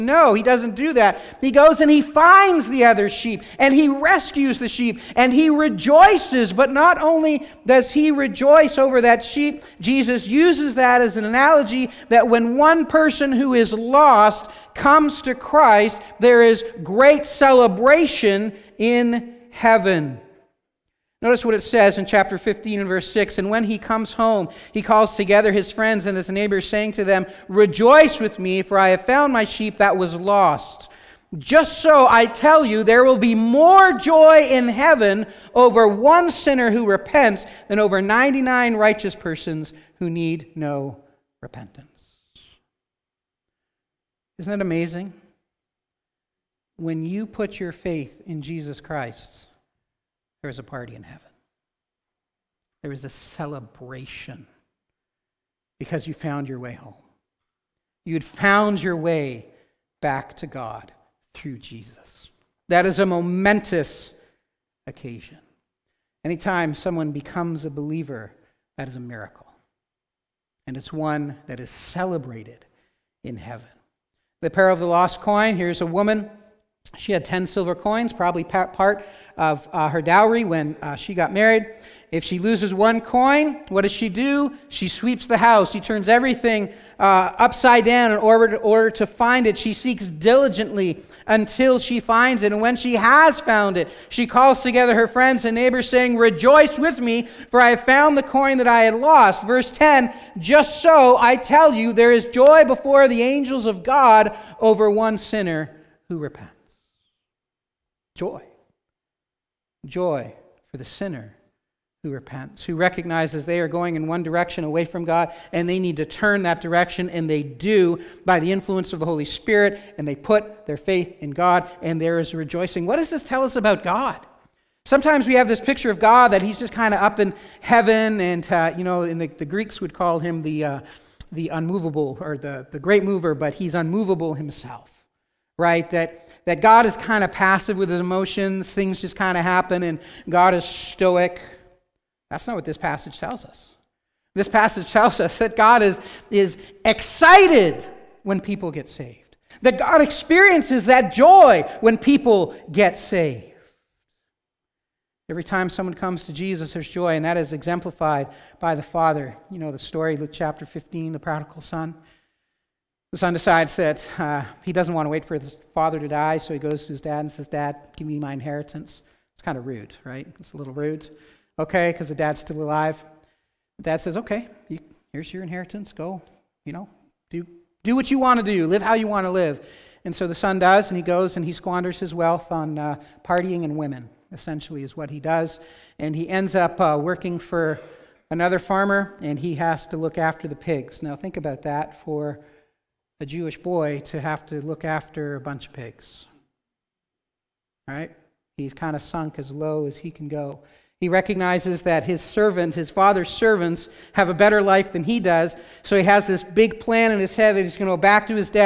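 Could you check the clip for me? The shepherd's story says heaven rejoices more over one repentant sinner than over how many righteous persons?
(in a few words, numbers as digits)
99.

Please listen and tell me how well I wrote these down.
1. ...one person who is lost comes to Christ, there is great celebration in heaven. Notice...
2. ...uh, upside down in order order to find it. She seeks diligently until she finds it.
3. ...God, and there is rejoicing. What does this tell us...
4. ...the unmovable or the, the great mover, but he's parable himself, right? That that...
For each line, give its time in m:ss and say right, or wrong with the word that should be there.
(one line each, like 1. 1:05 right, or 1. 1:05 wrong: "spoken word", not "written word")
1. 0:12 right
2. 1:27 right
3. 2:01 right
4. 2:11 wrong: "unmovable", not "parable".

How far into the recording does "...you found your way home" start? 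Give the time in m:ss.
0:56.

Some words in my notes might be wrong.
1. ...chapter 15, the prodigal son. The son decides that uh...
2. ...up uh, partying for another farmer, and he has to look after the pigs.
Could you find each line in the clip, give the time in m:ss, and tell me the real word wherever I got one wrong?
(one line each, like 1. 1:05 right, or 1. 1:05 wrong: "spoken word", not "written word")
1. 2:40 right
2. 3:06 wrong: "working", not "partying".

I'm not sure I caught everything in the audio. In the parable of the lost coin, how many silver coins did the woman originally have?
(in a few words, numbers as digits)
10.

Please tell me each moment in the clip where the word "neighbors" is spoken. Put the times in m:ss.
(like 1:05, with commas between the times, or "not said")
0:26, 1:35.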